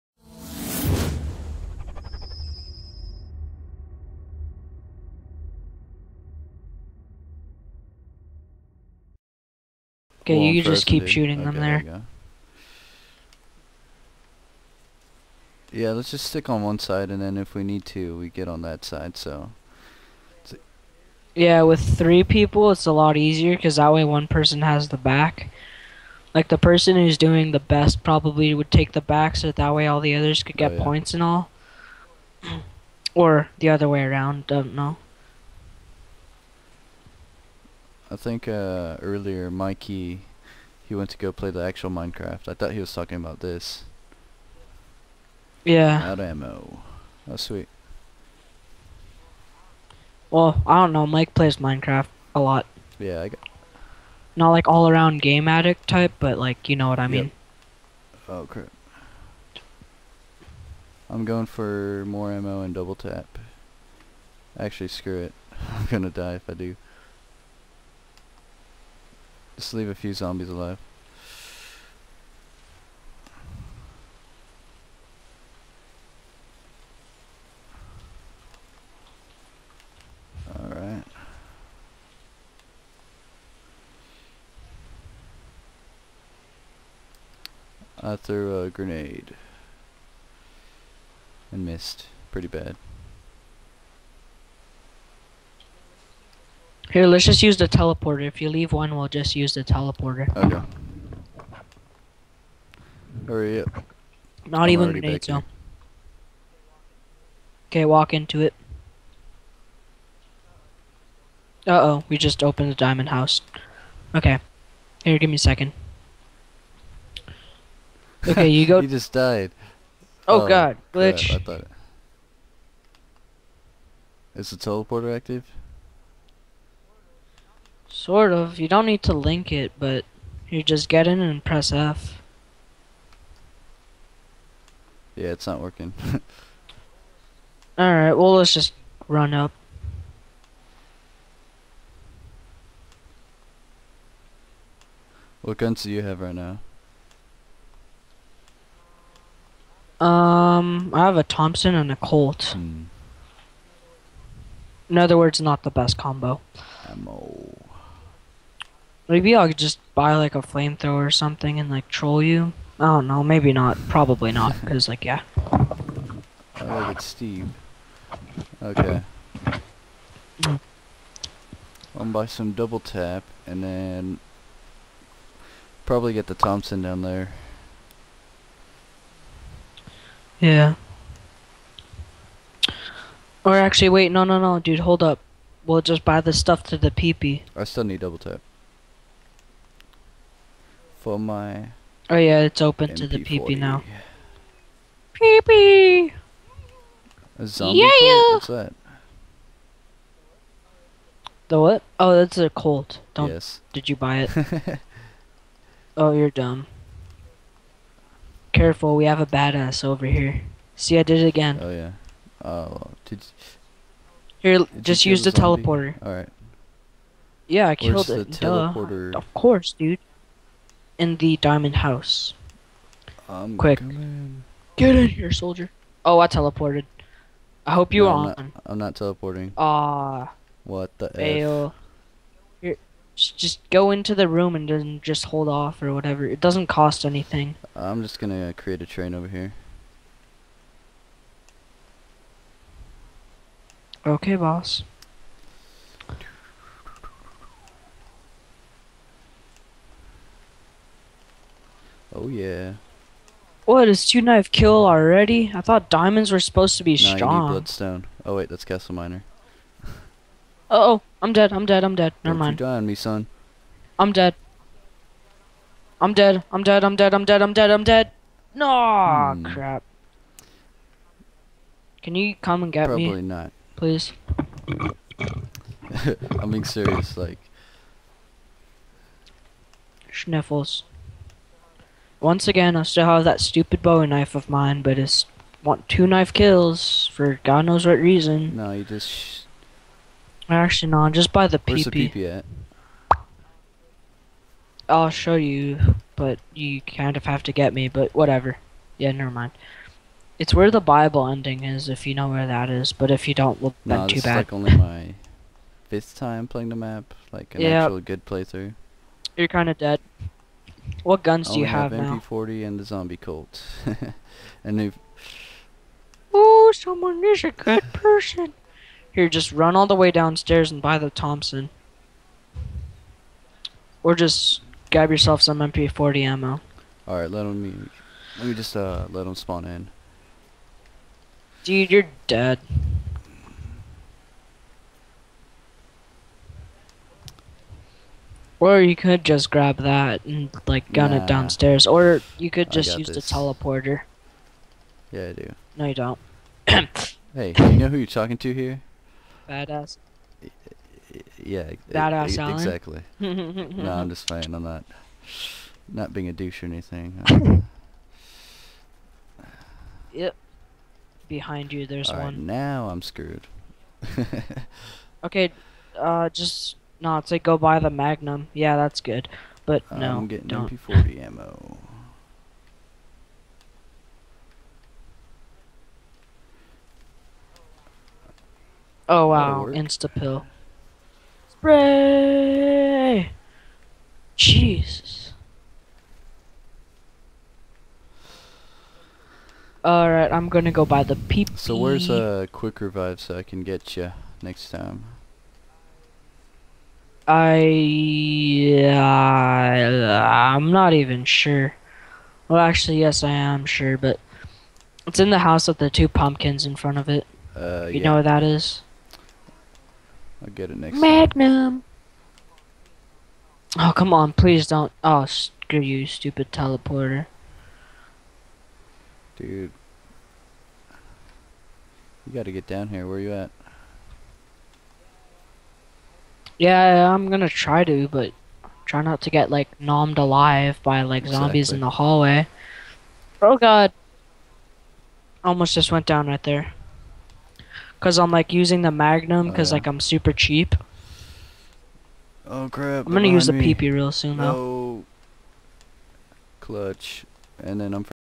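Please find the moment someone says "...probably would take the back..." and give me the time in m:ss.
0:28.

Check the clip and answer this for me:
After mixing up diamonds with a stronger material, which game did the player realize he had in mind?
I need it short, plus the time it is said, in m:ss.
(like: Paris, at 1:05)
CastleMiner, at 4:18.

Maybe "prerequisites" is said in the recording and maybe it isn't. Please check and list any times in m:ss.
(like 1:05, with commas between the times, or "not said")
not said.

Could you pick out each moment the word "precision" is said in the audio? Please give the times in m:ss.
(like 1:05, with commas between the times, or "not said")
not said.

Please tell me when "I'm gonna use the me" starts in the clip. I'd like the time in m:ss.
7:23.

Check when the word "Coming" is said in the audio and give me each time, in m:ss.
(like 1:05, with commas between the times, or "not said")
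3:43.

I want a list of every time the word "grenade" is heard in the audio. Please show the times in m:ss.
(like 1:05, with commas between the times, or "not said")
1:28, 1:44.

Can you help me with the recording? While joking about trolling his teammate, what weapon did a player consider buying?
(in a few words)
flamethrower.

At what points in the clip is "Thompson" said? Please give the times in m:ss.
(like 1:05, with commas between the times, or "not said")
2:31, 2:56, 5:21.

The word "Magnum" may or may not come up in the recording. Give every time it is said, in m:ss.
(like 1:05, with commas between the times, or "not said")
6:07, 6:50, 7:18.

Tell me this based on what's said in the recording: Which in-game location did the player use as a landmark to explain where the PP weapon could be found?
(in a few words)
Bible ending.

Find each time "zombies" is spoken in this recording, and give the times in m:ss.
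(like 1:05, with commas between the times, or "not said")
1:10, 3:17, 5:12, 7:11.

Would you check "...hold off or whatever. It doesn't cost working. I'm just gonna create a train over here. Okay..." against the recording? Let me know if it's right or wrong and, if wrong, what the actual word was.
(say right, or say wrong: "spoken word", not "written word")
wrong: "anything", not "working".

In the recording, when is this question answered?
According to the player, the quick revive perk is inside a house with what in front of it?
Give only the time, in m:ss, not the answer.
6:45.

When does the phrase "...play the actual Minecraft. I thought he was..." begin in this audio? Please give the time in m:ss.
0:41.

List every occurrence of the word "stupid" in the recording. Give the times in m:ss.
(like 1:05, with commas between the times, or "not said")
4:43, 6:56.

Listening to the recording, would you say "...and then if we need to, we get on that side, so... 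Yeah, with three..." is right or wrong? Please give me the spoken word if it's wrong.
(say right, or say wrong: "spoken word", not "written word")
right.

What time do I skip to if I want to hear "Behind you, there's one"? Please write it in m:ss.
6:01.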